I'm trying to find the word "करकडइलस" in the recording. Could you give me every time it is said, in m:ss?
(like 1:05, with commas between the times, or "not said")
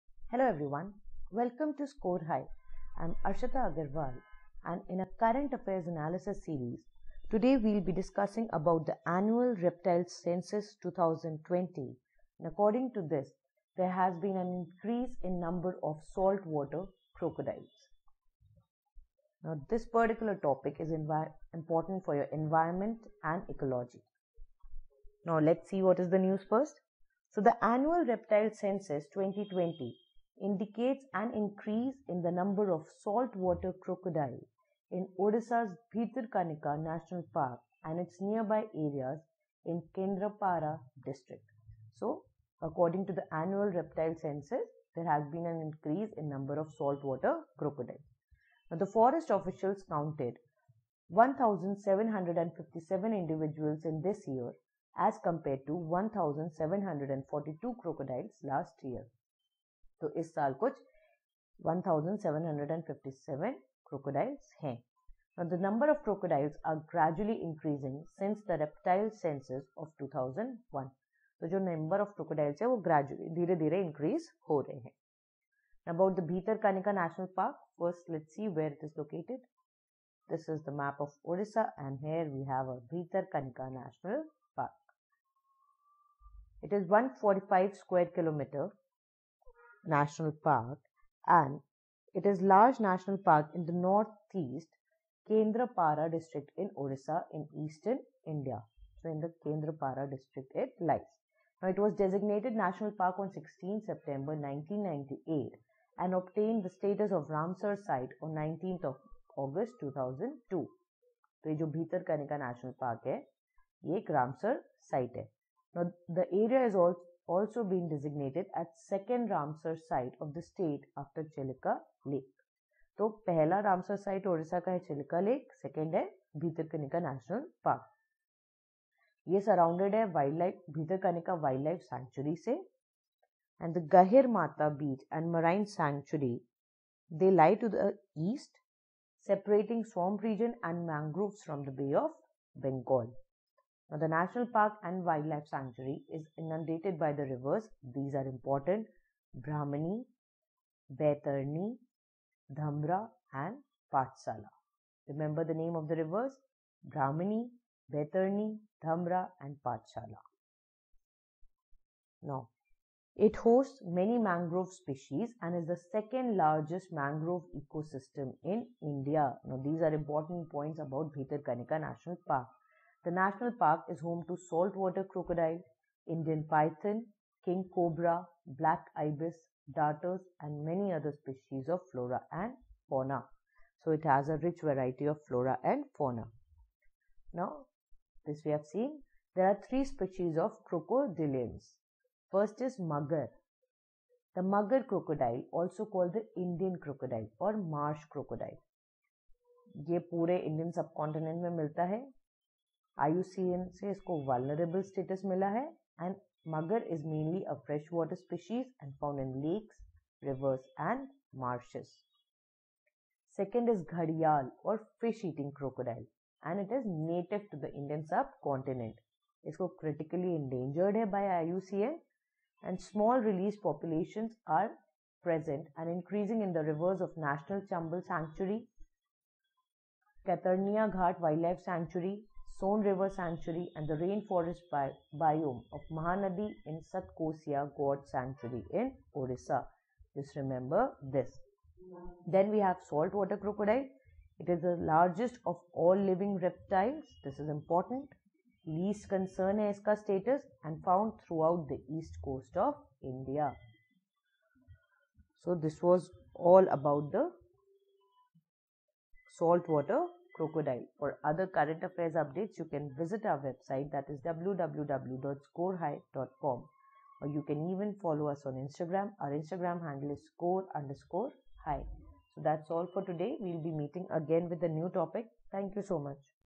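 1:03, 1:12.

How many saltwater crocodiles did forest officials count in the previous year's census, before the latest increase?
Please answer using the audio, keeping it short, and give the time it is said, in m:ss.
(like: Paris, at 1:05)
1,742, at 0:55.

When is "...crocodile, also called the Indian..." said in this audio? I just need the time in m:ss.
3:14.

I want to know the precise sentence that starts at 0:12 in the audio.
And according to this, there has been an increase in number of saltwater crocodiles.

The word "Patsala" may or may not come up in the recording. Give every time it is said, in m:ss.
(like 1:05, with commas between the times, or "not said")
2:33, 2:39.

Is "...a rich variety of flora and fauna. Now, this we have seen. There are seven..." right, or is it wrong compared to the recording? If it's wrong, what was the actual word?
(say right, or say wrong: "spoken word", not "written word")
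wrong: "three", not "seven".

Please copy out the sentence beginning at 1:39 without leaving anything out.
So in the Kendrapara district it lies.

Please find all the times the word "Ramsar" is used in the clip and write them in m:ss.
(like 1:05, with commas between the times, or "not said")
1:47, 1:59.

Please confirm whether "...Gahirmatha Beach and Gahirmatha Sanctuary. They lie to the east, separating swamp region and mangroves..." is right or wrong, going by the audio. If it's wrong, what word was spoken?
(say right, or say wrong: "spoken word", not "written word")
wrong: "Marine", not "Gahirmatha".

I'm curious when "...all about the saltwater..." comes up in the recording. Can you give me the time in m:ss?
4:16.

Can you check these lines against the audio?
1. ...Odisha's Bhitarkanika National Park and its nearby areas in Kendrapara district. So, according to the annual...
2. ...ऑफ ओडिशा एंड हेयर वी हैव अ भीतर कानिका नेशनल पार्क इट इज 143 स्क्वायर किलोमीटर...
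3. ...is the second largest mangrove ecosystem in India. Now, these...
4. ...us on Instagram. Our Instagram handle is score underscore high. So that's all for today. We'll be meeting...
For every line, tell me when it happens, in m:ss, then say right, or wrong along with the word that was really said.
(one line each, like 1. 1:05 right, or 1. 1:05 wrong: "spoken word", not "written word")
1. 0:35 right
2. 1:21 wrong: "145", not "143"
3. 2:45 right
4. 4:28 right.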